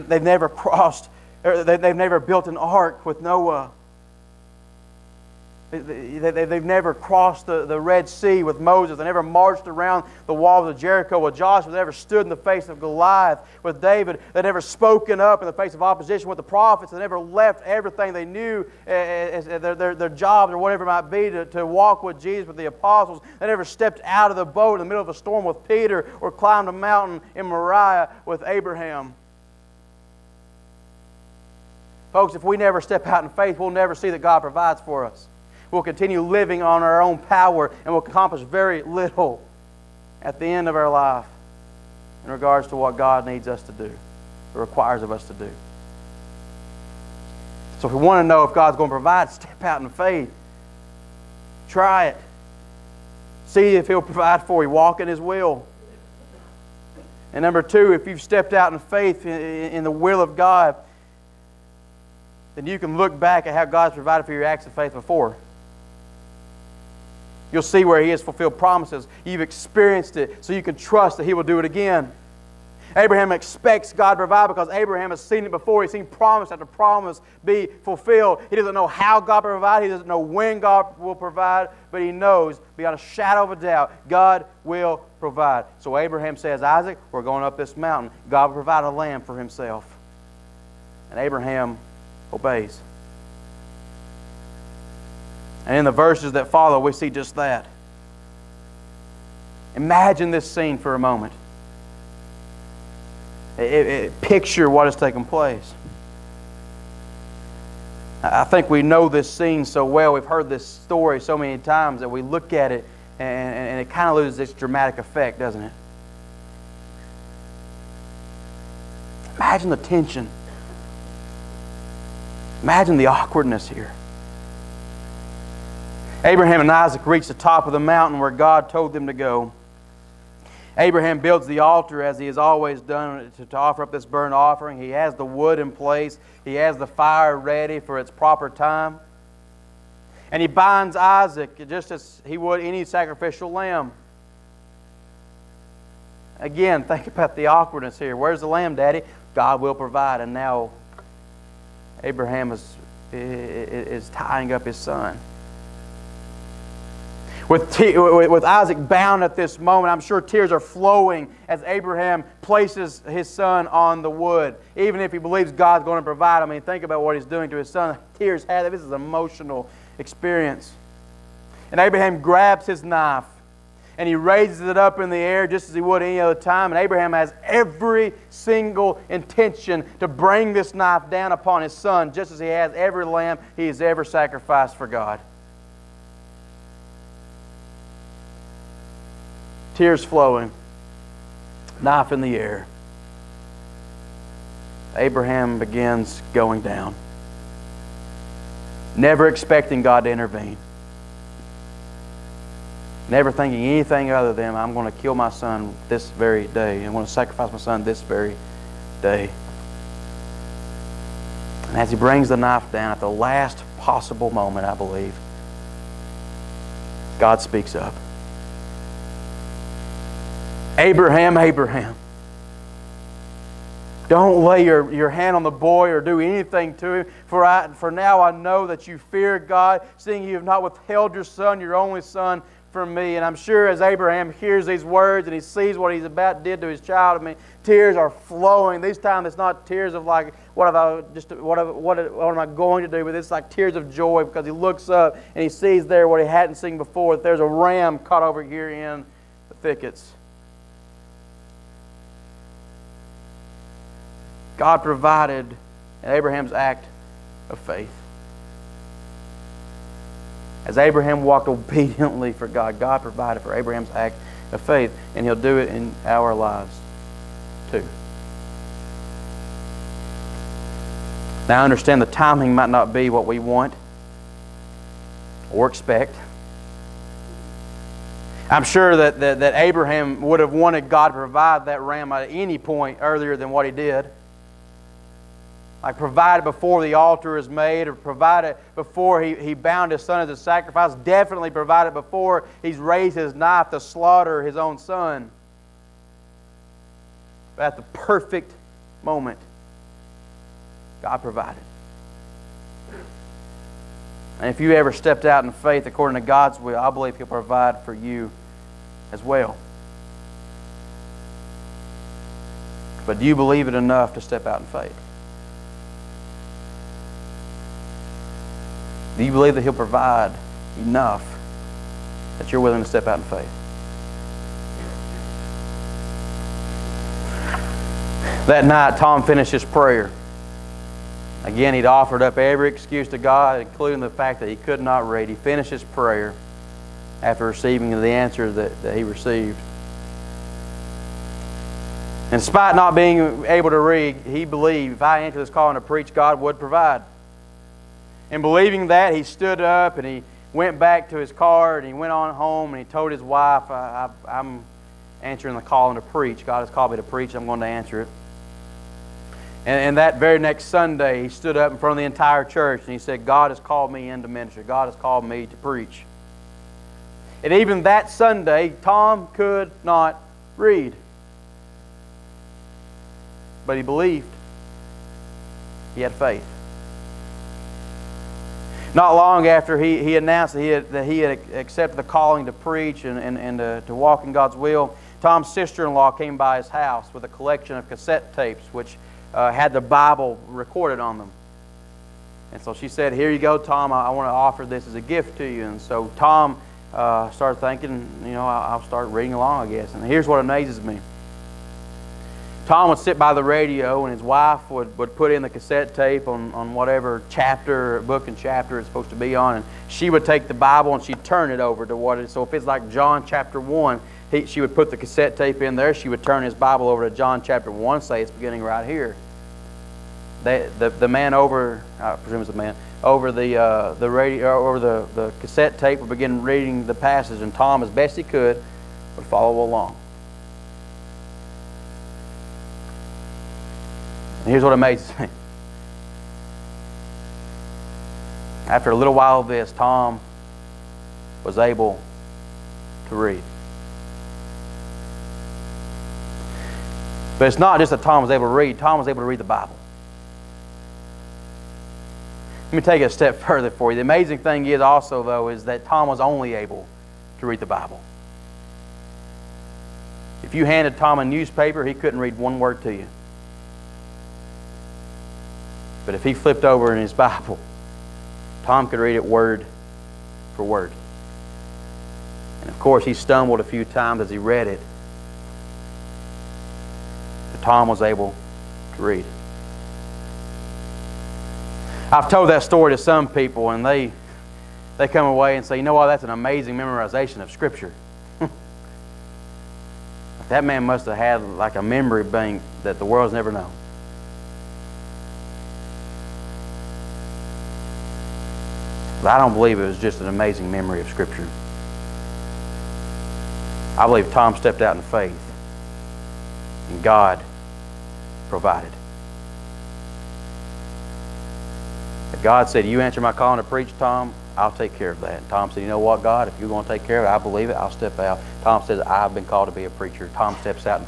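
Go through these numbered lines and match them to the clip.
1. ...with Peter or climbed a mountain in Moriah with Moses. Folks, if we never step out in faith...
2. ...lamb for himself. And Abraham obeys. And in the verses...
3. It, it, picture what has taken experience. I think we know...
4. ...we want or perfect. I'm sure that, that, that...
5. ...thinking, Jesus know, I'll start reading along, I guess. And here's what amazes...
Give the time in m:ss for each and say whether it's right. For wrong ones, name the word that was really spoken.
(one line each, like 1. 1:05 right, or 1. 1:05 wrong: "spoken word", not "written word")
1. 0:25 wrong: "Abraham", not "Moses"
2. 1:28 right
3. 1:43 wrong: "place", not "experience"
4. 4:33 wrong: "expect", not "perfect"
5. 6:37 wrong: "You", not "Jesus".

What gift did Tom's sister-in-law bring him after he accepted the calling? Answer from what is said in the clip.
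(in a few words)
Cassette tapes.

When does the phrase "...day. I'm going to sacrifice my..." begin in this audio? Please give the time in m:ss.
3:26.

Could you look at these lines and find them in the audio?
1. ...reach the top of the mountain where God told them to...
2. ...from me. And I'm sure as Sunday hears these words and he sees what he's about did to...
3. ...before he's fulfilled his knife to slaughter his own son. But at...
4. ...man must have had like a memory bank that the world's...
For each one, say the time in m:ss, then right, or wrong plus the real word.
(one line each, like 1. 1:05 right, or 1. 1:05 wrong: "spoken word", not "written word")
1. 2:07 right
2. 3:52 wrong: "Abraham", not "Sunday"
3. 4:51 wrong: "raised", not "fulfilled"
4. 8:10 right.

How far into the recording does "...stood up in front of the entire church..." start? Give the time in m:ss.
6:01.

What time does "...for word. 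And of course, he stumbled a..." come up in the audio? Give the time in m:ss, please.
7:50.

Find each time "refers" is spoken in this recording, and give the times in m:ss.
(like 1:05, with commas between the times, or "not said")
not said.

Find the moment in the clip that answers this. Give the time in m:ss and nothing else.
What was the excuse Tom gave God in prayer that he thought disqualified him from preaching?
5:34.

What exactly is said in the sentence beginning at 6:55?
She would turn his Bible over to John chapter 1, say it's beginning right here.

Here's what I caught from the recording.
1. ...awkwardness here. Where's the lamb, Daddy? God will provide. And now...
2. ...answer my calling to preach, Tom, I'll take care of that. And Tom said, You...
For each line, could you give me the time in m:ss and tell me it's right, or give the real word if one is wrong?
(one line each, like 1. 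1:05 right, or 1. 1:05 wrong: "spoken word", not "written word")
1. 2:27 right
2. 8:33 right.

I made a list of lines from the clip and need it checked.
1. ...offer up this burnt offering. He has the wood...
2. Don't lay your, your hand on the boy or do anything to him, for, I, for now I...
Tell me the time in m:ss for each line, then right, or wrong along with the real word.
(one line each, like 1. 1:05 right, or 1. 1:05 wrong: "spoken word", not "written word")
1. 2:13 right
2. 3:44 right.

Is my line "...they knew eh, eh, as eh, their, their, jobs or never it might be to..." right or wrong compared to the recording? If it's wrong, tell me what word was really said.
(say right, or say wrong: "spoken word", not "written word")
wrong: "whatever", not "never".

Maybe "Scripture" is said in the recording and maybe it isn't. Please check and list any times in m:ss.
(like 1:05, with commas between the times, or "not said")
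8:07, 8:21.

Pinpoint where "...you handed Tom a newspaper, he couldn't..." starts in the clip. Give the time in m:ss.
7:40.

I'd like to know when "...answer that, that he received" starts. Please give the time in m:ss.
5:38.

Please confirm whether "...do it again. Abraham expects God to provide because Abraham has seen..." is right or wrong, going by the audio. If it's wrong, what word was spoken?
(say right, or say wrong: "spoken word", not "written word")
right.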